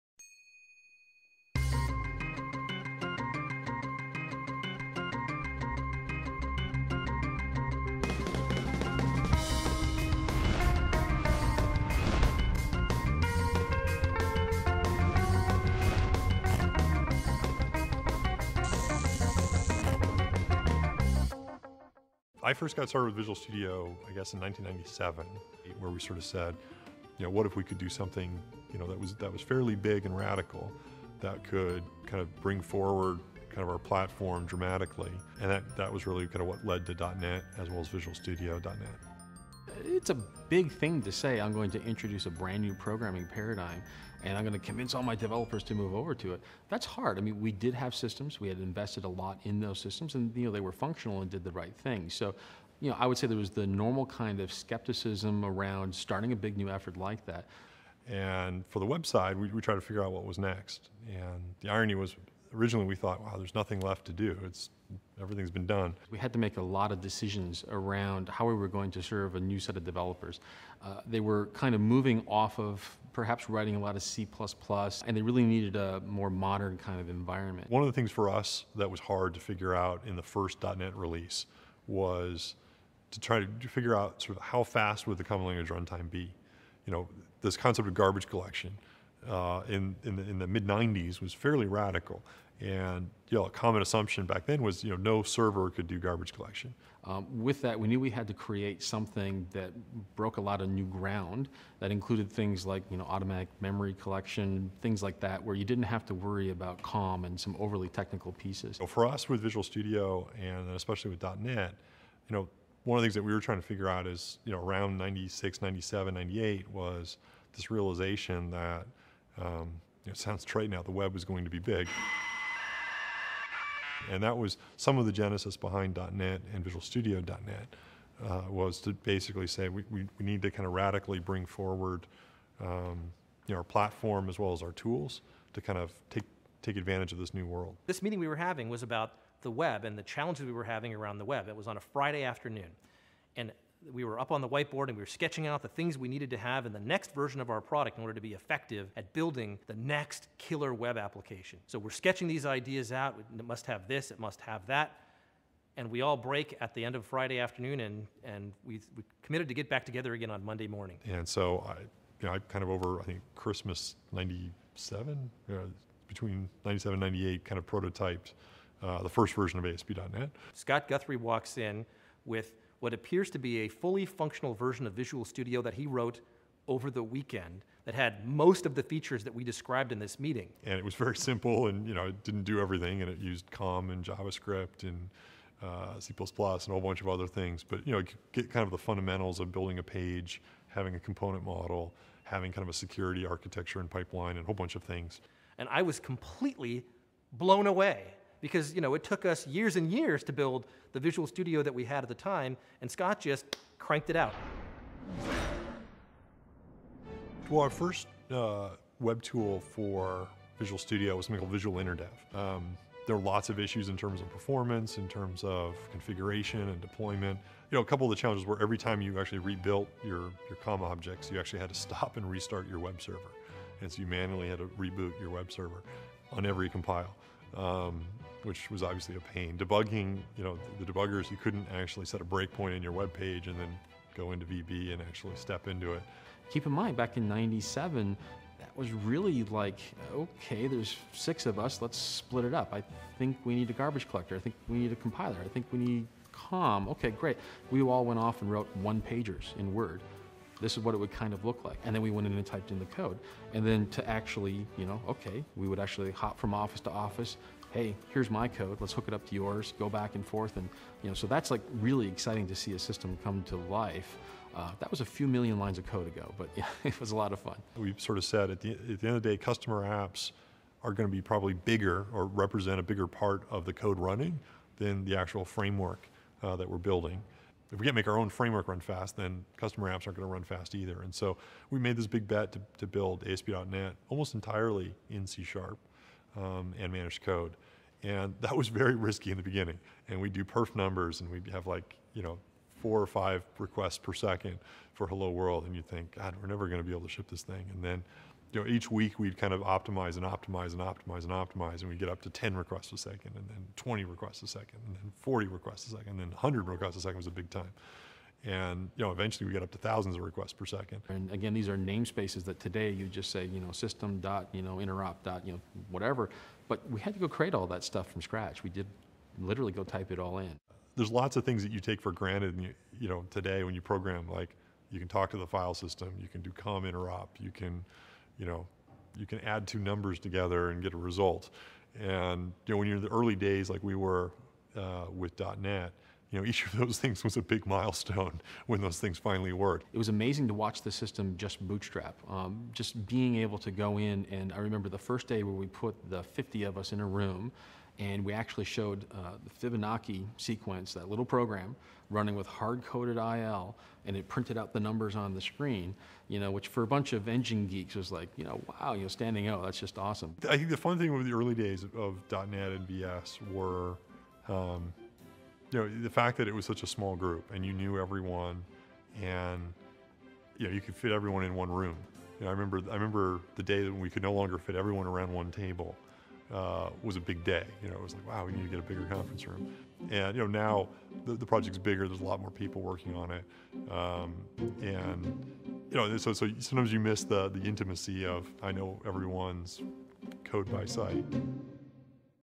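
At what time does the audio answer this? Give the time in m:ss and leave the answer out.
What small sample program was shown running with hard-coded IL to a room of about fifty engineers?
5:49.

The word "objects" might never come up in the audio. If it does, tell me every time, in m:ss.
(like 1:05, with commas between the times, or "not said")
3:40.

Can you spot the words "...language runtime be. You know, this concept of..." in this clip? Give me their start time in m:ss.
1:25.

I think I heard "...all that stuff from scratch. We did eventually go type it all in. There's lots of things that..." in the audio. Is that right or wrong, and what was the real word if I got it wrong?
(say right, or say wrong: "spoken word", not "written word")
wrong: "literally", not "eventually".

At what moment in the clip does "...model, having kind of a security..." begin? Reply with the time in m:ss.
3:11.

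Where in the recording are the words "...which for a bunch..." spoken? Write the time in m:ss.
5:56.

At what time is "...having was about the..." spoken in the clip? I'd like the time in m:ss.
2:18.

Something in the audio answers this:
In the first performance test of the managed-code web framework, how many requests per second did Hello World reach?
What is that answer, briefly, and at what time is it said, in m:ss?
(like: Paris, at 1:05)
4 or 5, at 4:52.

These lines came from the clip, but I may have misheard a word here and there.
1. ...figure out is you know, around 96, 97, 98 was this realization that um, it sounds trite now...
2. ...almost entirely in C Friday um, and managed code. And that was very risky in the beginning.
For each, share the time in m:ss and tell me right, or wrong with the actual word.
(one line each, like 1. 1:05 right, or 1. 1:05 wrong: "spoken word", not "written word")
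1. 1:53 right
2. 4:44 wrong: "Sharp", not "Friday".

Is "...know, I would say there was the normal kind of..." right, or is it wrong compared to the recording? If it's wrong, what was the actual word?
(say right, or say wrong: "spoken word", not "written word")
right.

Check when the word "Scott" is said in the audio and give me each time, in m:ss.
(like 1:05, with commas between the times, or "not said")
2:50, 3:22.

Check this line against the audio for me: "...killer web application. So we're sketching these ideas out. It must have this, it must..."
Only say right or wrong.
right.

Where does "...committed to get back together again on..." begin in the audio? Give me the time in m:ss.
2:39.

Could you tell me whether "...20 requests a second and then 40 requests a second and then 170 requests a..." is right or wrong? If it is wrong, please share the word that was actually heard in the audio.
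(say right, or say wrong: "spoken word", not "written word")
wrong: "100", not "170".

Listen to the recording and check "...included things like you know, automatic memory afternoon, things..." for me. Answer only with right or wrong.
wrong.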